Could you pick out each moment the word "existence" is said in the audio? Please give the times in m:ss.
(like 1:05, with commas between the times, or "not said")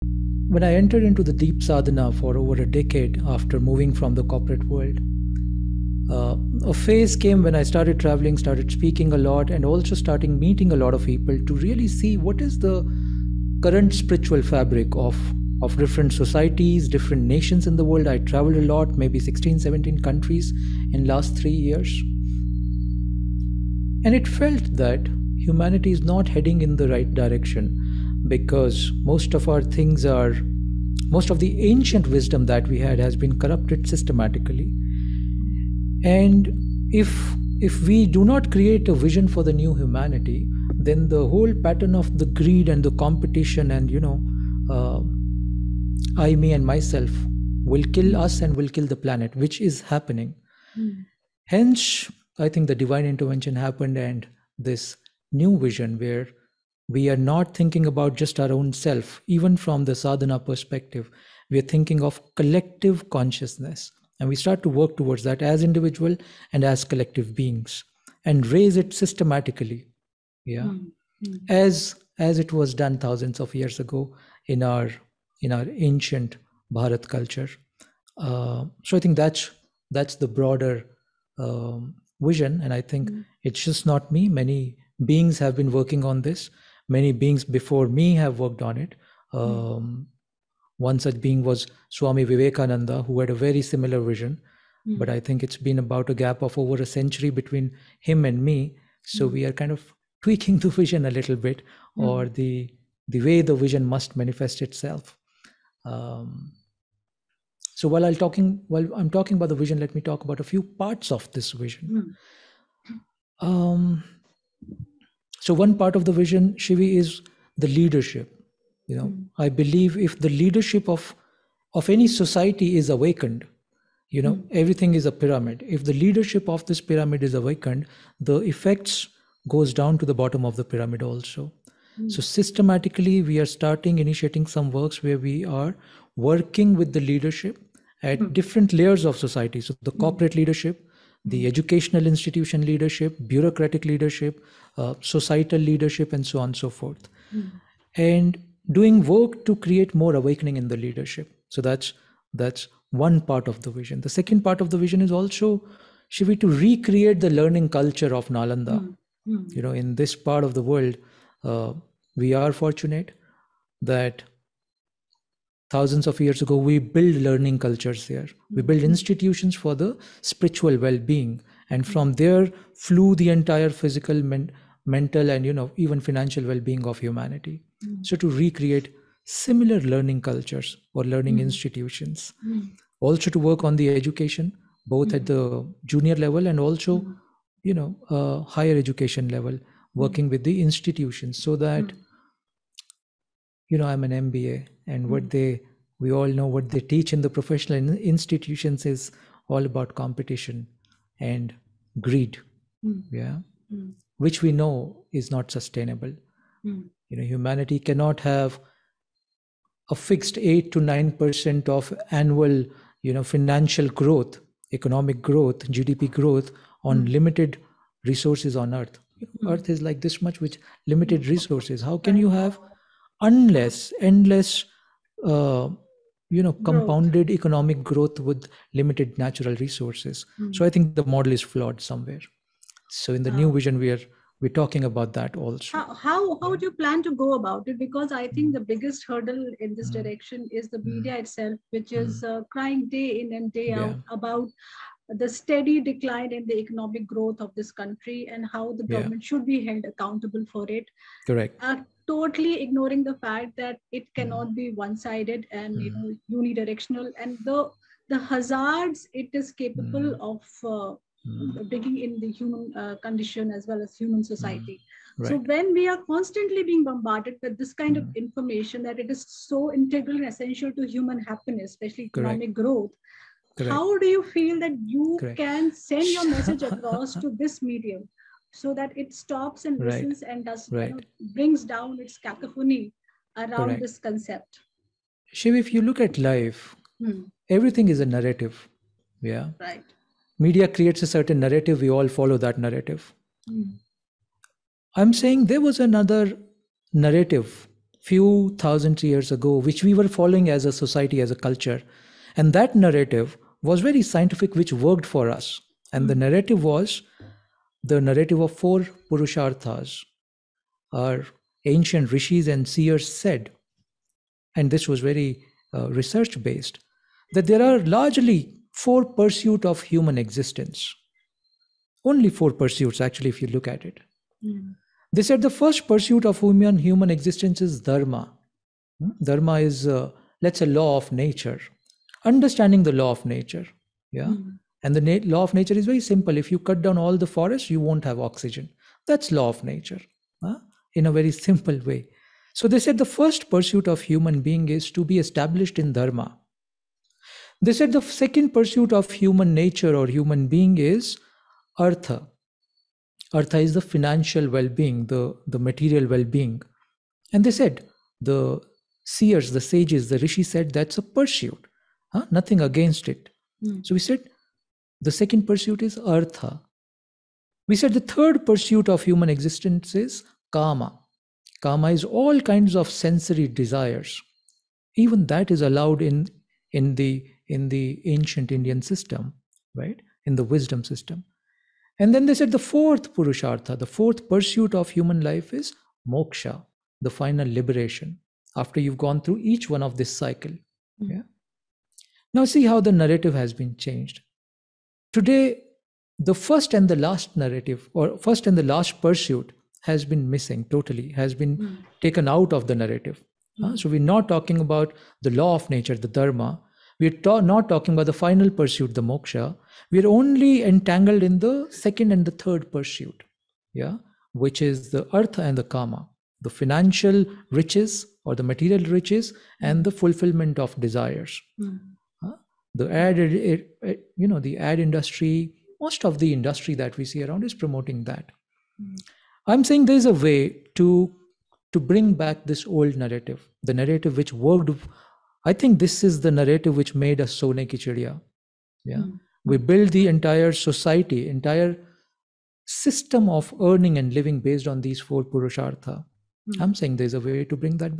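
5:20, 5:27, 6:09.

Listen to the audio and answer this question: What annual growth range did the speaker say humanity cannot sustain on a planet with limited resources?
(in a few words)
8 to 9 percent.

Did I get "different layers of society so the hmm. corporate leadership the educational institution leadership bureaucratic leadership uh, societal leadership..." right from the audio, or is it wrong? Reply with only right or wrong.
right.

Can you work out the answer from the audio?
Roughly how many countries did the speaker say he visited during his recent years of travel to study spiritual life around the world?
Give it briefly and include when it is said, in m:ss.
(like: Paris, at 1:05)
16 or 17, at 0:19.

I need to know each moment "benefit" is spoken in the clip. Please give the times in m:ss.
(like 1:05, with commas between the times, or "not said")
not said.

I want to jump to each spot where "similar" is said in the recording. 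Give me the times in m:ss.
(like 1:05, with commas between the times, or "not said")
1:33, 2:59.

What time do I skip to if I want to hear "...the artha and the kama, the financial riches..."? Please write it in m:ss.
6:54.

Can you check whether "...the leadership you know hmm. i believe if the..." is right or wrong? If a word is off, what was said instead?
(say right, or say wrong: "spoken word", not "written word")
right.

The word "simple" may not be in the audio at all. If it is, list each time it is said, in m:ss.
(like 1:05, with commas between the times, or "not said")
5:36, 5:41.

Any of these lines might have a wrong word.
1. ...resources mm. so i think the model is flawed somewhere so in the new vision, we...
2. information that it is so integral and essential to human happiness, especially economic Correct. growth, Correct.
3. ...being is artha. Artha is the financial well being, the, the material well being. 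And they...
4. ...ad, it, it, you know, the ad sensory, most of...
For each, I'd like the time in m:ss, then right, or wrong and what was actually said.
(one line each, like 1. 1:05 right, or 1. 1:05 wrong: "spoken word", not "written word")
1. 3:49 right
2. 4:28 right
3. 5:50 right
4. 7:02 wrong: "industry", not "sensory".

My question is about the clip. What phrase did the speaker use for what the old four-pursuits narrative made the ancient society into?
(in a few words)
Sone Ki Chidiya.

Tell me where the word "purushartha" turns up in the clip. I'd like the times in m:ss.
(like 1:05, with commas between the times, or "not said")
5:09, 6:23, 7:25.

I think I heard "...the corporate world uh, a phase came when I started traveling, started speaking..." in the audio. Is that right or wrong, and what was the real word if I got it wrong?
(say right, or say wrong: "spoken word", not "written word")
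right.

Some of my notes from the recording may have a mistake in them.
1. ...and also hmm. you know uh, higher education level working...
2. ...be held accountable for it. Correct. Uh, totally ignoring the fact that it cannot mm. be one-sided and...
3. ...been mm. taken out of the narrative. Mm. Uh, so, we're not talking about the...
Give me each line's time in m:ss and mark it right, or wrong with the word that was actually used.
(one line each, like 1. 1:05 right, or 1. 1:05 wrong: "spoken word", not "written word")
1. 3:06 right
2. 4:09 right
3. 6:41 right.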